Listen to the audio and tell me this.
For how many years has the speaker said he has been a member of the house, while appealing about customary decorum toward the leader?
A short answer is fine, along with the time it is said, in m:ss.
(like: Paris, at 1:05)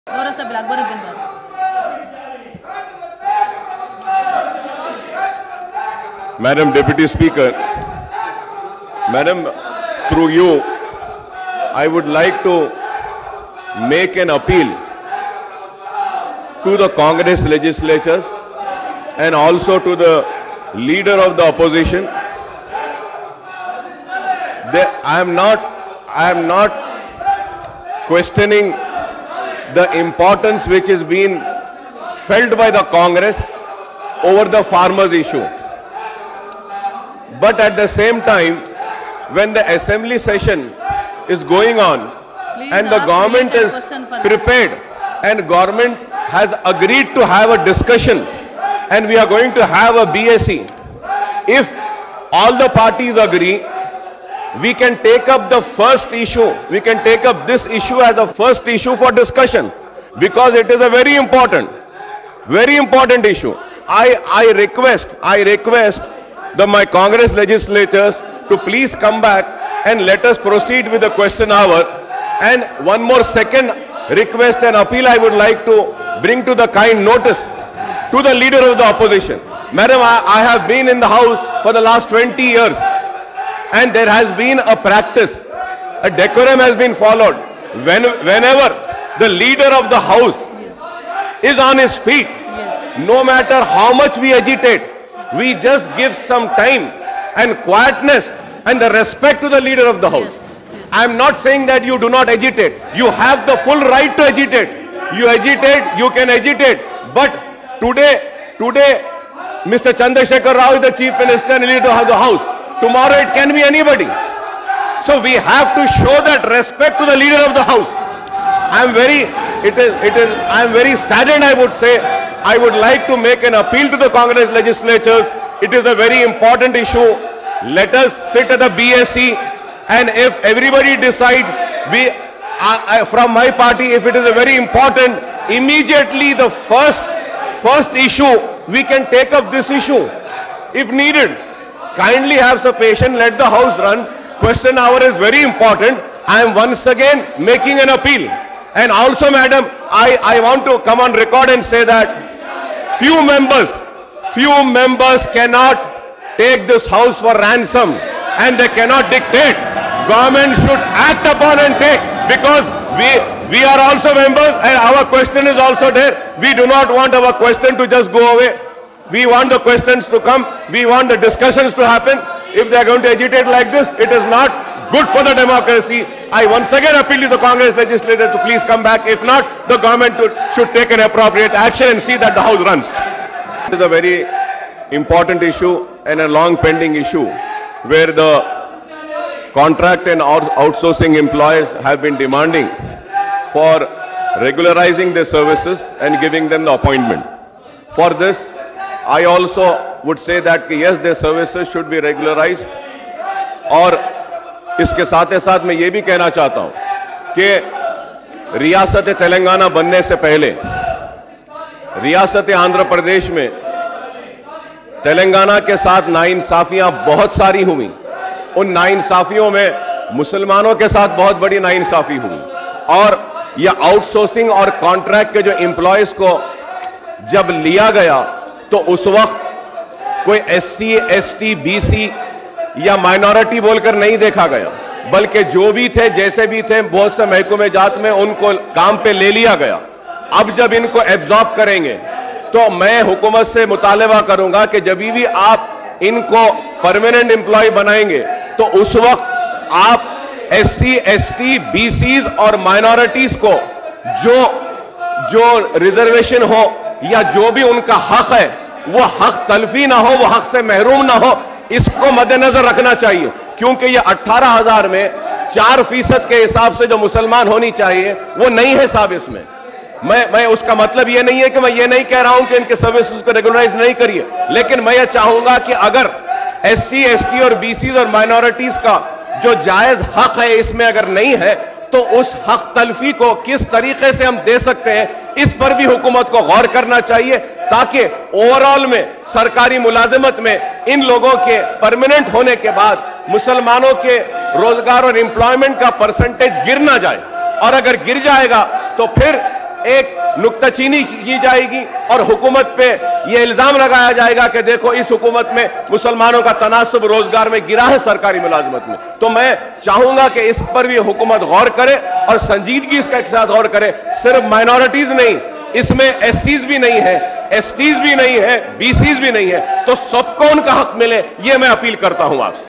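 20 years, at 1:22.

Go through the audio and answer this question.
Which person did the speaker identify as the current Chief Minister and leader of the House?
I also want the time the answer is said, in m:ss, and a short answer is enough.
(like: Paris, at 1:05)
Chandrasekhar Rao, at 1:49.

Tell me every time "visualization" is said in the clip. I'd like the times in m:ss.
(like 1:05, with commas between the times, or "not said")
not said.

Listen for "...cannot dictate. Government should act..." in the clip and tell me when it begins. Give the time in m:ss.
2:38.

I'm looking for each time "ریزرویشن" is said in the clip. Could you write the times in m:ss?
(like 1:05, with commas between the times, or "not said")
4:15.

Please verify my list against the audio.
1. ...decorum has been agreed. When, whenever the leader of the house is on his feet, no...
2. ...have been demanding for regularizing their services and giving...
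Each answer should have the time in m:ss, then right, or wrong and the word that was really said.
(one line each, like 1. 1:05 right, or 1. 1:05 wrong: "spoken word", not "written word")
1. 1:26 wrong: "followed", not "agreed"
2. 3:11 right.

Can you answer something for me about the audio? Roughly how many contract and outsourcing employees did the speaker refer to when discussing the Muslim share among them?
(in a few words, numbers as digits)
18,000.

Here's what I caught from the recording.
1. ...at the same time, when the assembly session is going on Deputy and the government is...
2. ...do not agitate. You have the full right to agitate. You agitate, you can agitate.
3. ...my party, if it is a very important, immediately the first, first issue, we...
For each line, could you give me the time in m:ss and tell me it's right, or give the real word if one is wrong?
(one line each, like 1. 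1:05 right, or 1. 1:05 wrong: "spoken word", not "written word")
1. 0:37 wrong: "Please", not "Deputy"
2. 1:41 right
3. 2:13 right.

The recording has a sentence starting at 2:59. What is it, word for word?
If not, the government should take an appropriate action and see that the House runs.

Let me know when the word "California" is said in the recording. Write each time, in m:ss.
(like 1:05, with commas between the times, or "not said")
not said.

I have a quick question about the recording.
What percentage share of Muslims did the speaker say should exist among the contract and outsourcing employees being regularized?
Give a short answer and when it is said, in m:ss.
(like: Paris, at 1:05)
4%, at 4:25.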